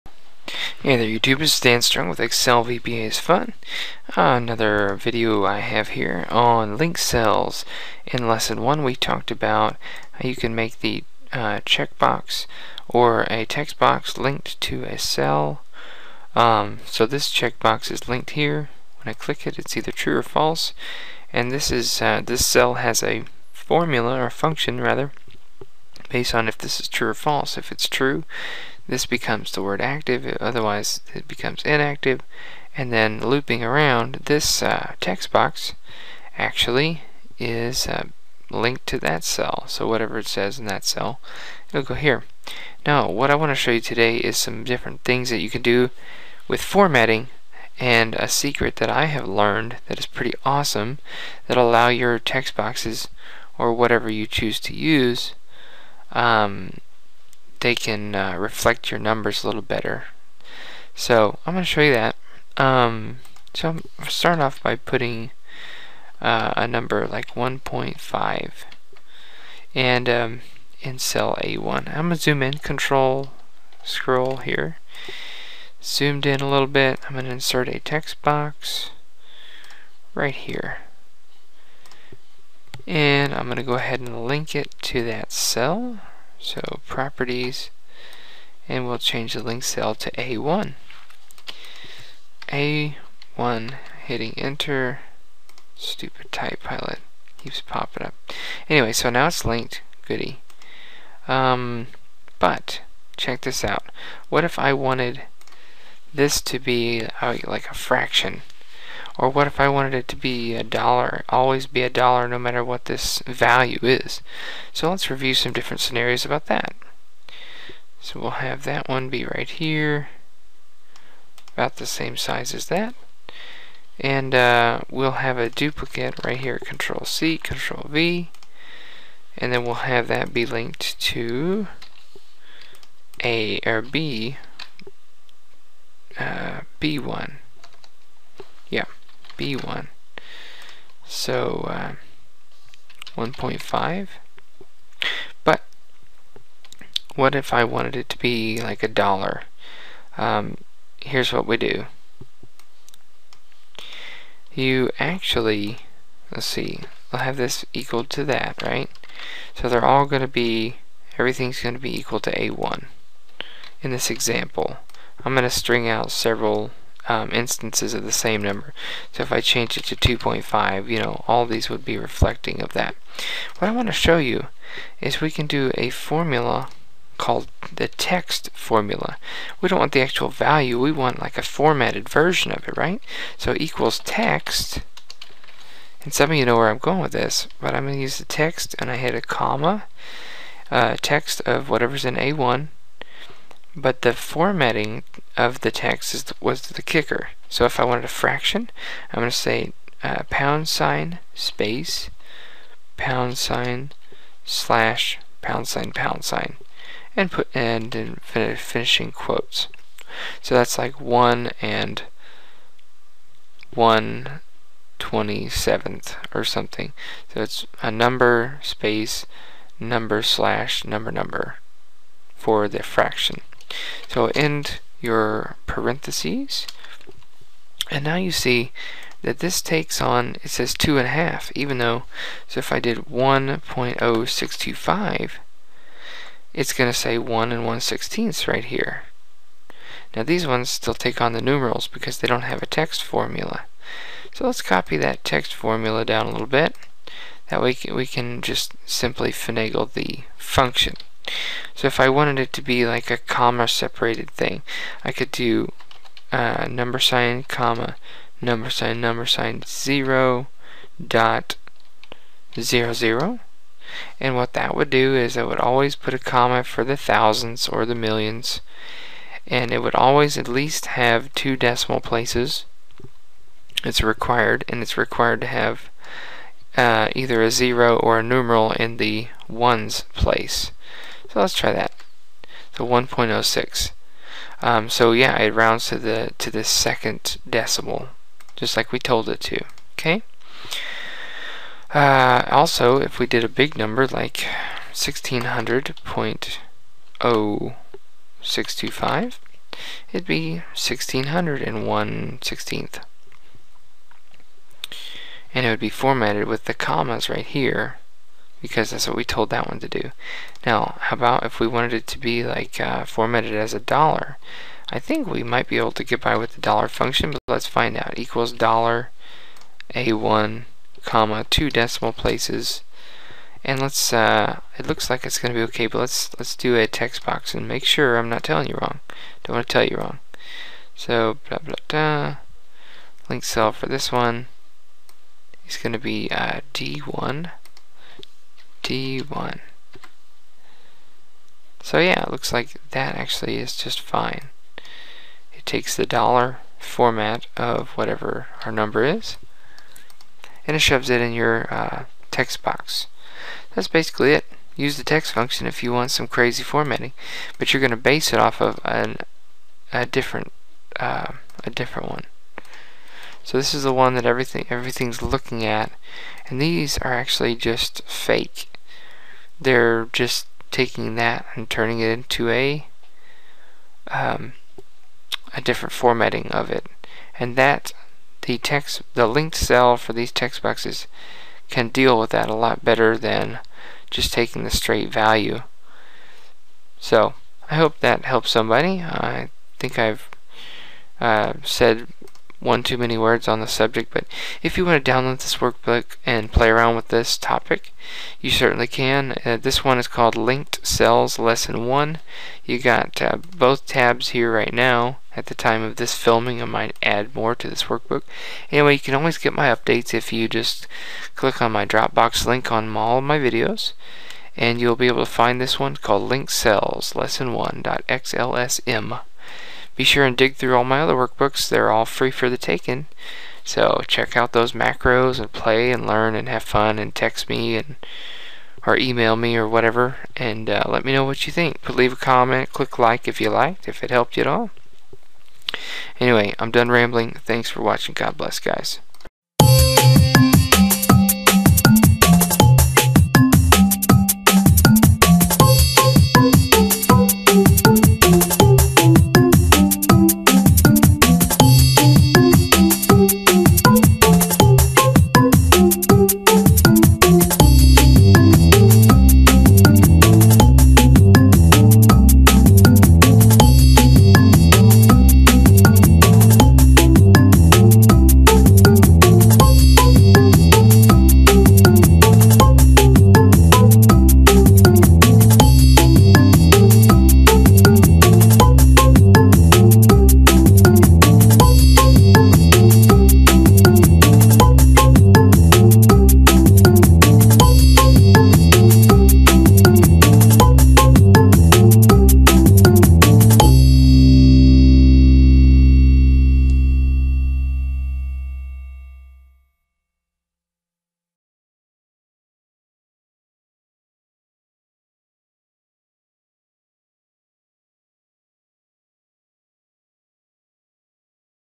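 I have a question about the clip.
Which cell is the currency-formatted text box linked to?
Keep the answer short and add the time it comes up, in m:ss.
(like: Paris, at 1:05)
D1, at 5:36.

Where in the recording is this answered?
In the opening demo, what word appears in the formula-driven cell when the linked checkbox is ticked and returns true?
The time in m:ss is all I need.
0:29.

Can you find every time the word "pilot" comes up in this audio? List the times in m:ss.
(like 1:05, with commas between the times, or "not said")
1:36.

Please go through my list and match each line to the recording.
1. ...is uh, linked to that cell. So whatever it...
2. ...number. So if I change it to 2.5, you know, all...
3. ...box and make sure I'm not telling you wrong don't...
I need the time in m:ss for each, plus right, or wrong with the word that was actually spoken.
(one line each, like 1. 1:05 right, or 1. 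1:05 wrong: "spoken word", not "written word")
1. 0:37 right
2. 2:48 right
3. 5:27 right.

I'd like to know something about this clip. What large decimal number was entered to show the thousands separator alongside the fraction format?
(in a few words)
1600.0625.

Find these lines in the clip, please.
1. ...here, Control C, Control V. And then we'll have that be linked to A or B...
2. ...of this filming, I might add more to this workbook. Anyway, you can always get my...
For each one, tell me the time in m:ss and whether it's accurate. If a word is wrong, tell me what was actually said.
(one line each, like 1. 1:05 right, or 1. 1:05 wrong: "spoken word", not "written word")
1. 2:06 right
2. 6:45 right.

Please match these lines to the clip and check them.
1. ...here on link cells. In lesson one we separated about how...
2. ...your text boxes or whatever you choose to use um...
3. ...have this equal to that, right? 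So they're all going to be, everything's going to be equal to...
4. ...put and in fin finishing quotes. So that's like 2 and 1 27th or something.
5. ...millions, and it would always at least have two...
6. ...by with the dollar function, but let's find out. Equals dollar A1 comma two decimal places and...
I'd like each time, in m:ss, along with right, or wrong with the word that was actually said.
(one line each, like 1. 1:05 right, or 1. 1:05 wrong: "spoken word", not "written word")
1. 0:05 wrong: "talked", not "separated"
2. 0:51 right
3. 2:37 right
4. 3:27 wrong: "1", not "2"
5. 4:27 right
6. 5:16 right.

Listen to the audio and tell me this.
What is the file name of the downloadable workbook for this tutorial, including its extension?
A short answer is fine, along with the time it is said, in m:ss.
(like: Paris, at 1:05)
Linked Cells Lesson 1.xlsm, at 6:56.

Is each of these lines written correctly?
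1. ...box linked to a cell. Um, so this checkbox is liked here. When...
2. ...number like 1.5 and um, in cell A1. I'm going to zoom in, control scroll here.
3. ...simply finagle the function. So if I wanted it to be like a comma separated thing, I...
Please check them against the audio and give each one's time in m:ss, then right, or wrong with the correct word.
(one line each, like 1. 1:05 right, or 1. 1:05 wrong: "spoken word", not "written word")
1. 0:13 wrong: "linked", not "liked"
2. 1:06 right
3. 4:08 right.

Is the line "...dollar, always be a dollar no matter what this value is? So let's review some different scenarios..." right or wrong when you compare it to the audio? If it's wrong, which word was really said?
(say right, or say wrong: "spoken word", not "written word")
right.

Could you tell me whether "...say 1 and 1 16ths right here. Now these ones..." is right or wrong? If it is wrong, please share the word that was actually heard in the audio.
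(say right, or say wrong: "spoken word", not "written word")
right.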